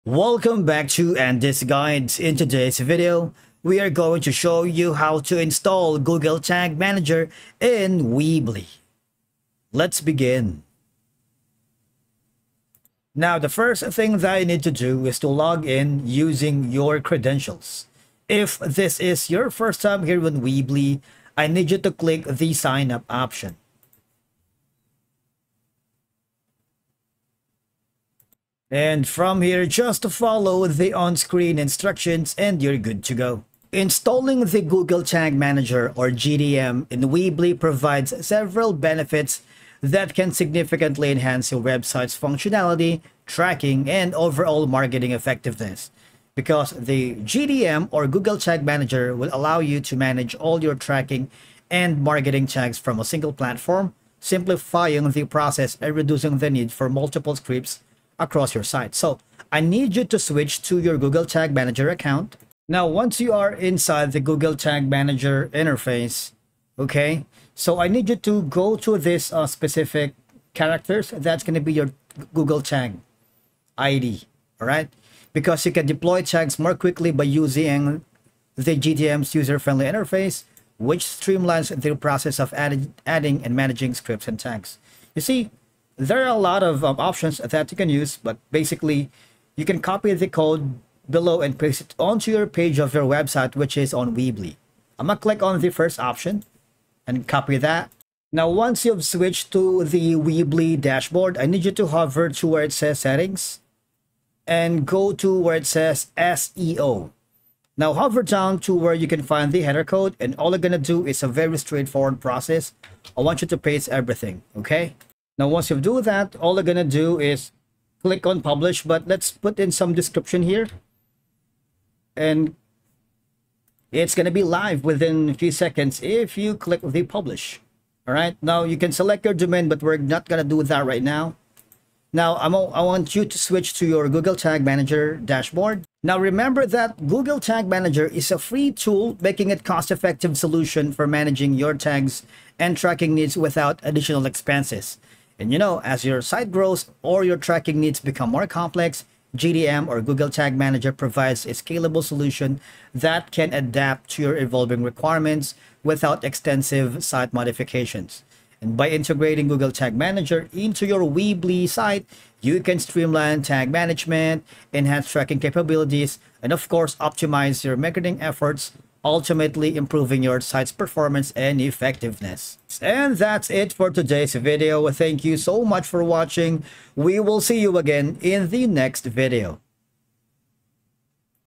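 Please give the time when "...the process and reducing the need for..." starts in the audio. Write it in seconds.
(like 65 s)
55 s.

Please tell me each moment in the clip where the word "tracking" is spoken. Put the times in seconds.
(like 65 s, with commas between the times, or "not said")
43 s, 50 s, 142 s, 147 s, 165 s.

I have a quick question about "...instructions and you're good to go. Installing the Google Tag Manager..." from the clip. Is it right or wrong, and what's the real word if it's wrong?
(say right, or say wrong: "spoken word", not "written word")
right.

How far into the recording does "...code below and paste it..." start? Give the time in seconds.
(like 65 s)
90 s.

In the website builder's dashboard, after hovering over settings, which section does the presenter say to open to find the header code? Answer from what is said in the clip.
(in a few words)
SEO.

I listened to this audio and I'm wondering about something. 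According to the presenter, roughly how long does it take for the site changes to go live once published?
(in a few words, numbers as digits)
a few seconds.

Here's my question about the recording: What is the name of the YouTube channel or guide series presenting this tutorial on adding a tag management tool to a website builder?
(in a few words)
Andy's Guides.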